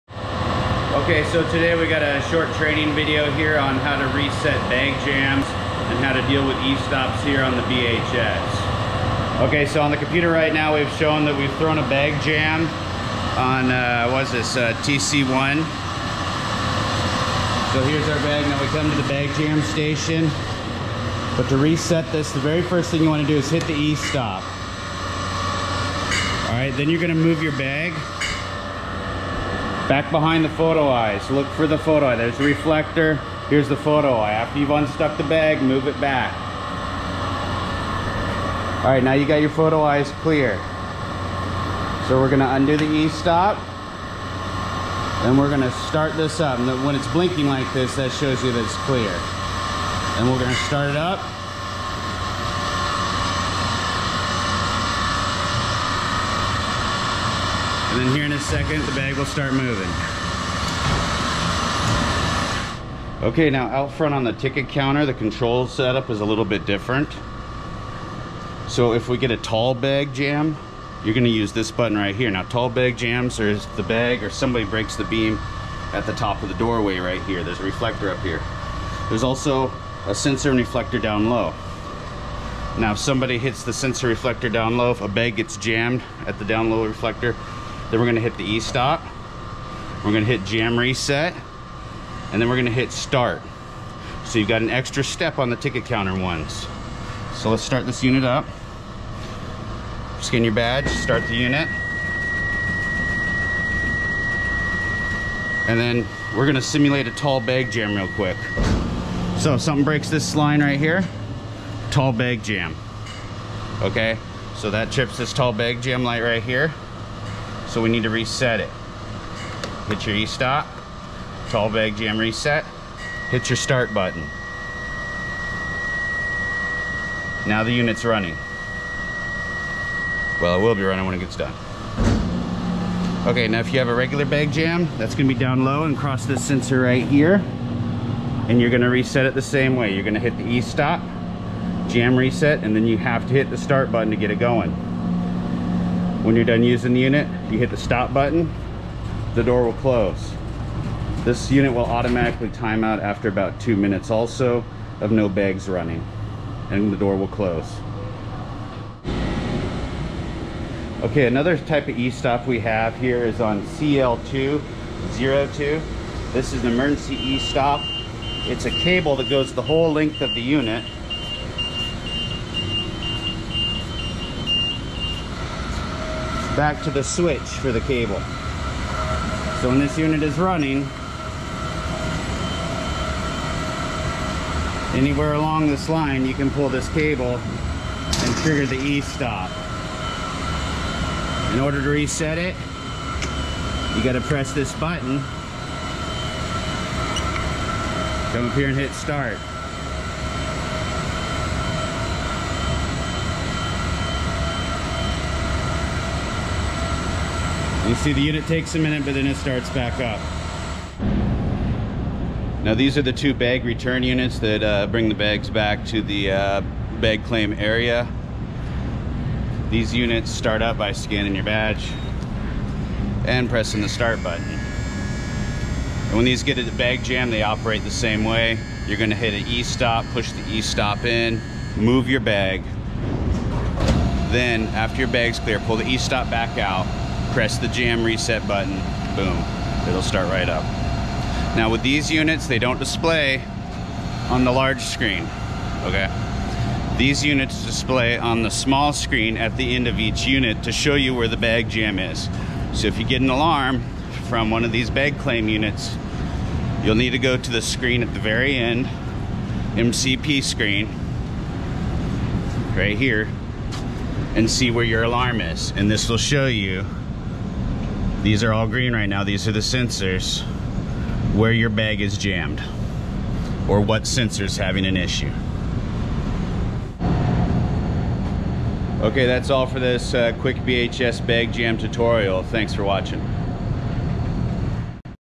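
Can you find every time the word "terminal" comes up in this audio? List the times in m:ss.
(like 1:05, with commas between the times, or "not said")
not said.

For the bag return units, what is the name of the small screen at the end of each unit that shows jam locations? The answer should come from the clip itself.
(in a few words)
MCP screen.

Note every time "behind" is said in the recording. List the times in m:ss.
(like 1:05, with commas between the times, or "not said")
0:30.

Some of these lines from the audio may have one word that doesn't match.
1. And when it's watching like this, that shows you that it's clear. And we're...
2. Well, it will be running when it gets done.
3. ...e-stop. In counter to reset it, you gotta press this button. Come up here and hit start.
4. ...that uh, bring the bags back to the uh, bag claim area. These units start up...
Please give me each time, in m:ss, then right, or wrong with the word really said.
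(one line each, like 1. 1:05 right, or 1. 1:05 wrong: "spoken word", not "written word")
1. 0:46 wrong: "blinking", not "watching"
2. 2:10 right
3. 3:08 wrong: "order", not "counter"
4. 3:34 right.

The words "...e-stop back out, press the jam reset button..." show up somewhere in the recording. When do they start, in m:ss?
3:55.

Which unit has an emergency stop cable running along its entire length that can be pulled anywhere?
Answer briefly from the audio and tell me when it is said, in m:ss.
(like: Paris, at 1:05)
CL202, at 2:43.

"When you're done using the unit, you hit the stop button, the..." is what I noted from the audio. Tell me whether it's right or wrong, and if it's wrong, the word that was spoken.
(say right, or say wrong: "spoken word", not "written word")
right.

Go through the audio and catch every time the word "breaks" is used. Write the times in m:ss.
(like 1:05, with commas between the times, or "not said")
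1:14, 1:49.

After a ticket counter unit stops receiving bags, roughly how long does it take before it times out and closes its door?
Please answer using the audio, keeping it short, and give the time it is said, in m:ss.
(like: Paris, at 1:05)
2 minutes, at 2:33.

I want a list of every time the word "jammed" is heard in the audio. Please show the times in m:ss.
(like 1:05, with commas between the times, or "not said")
1:25, 4:32.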